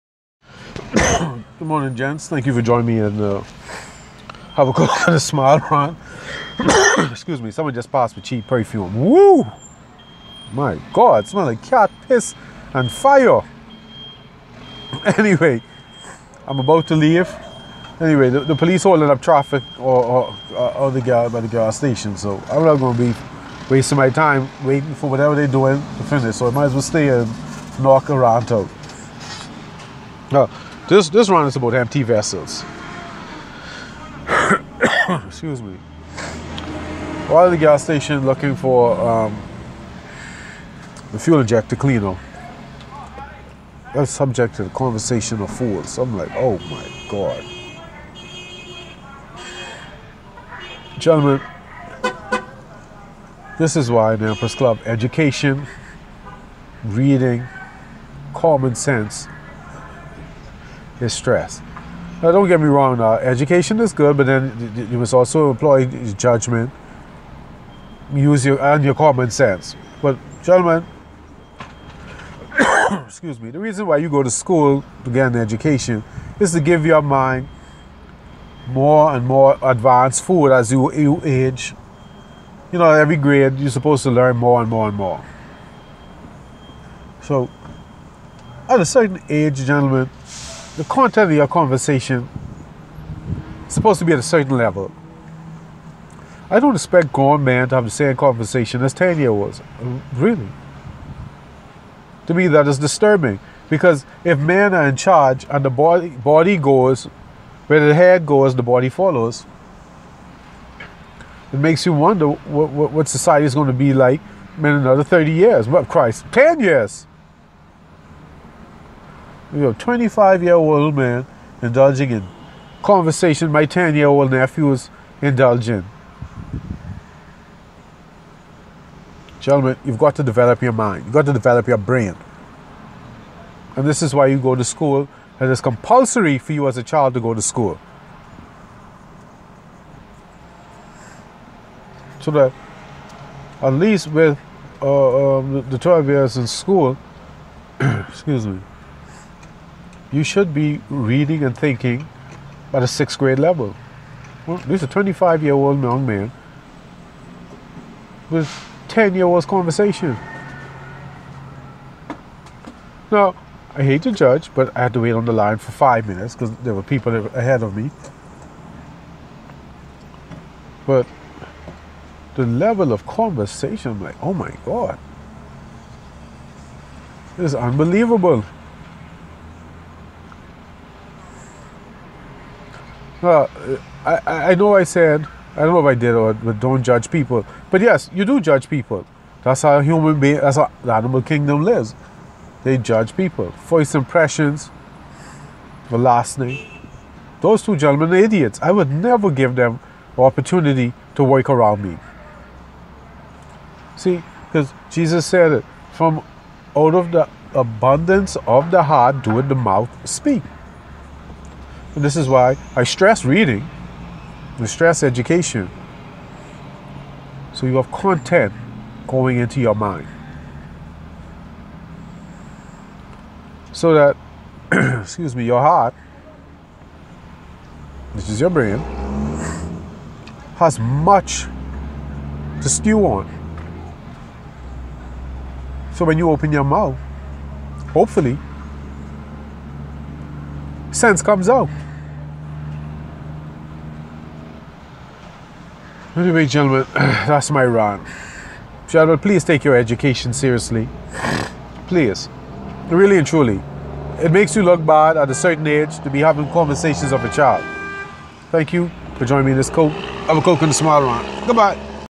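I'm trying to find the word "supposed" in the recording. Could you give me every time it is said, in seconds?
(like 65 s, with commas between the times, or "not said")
83 s, 93 s.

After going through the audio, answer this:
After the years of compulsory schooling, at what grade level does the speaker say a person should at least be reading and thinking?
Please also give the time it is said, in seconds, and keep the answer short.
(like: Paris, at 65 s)
sixth grade, at 152 s.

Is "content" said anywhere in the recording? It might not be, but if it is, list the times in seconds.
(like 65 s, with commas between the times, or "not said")
90 s, 217 s.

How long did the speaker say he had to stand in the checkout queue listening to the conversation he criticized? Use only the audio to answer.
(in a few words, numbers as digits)
5 minutes.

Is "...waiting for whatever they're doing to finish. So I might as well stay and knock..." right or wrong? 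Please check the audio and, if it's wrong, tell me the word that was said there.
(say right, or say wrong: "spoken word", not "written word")
right.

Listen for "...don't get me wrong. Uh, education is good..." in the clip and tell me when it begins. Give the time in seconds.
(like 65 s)
62 s.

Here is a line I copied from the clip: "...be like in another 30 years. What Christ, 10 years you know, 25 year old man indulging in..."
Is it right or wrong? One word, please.
right.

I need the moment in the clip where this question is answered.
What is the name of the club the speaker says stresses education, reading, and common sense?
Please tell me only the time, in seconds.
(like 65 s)
54 s.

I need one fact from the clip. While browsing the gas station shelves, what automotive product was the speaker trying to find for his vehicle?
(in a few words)
fuel injector cleaner.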